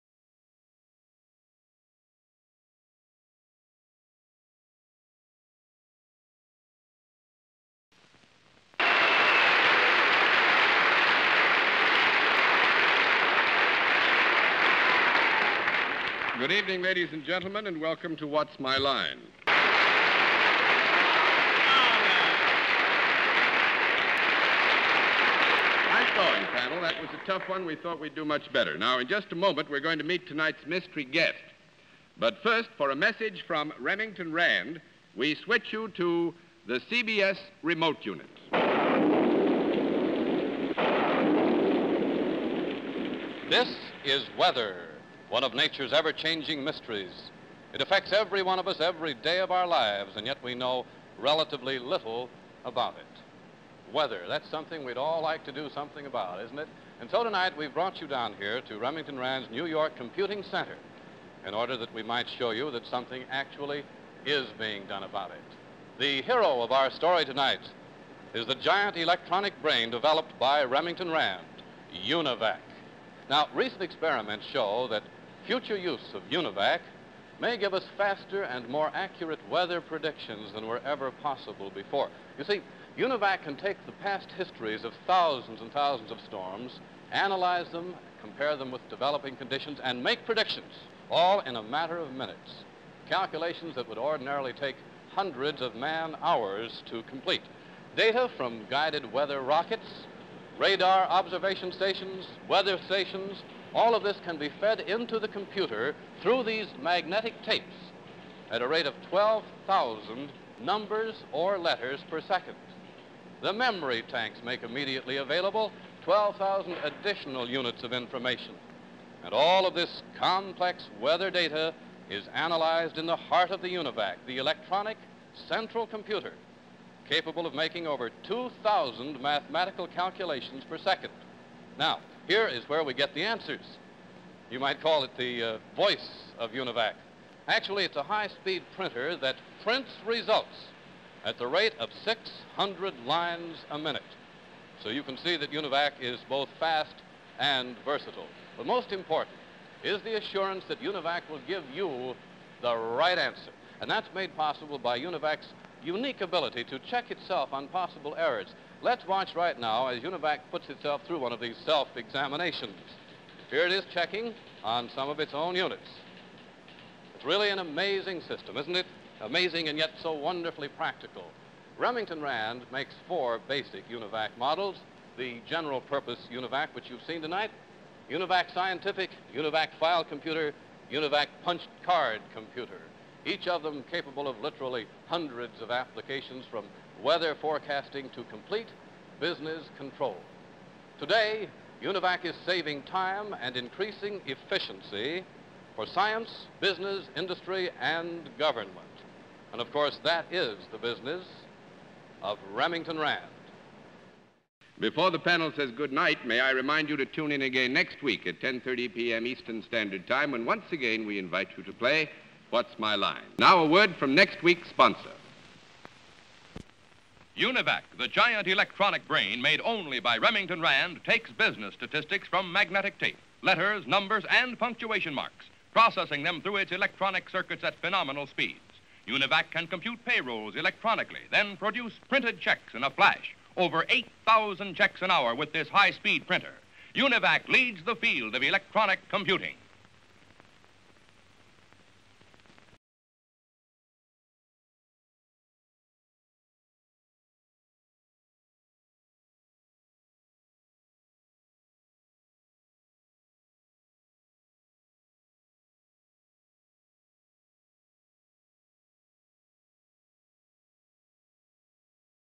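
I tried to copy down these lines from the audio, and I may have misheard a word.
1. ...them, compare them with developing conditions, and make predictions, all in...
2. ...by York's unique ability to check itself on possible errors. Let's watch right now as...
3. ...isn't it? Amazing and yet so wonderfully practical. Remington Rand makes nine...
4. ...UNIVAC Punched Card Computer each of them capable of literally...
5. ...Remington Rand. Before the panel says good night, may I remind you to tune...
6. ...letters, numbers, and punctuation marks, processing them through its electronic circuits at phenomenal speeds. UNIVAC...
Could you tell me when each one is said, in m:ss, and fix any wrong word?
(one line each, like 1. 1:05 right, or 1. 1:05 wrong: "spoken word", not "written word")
1. 1:27 right
2. 2:34 wrong: "UNIVAC", not "York"
3. 2:48 wrong: "four", not "nine"
4. 3:00 right
5. 3:22 right
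6. 3:43 right.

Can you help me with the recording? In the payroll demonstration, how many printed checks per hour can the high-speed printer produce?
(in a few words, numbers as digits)
over 8,000.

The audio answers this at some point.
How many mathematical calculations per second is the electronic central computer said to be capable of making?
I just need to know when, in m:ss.
2:07.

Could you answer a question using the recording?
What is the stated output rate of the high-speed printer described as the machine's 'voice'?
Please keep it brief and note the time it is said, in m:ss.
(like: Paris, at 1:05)
600 lines a minute, at 2:22.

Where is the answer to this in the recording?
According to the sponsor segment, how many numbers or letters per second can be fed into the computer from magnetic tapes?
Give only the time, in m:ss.
1:49.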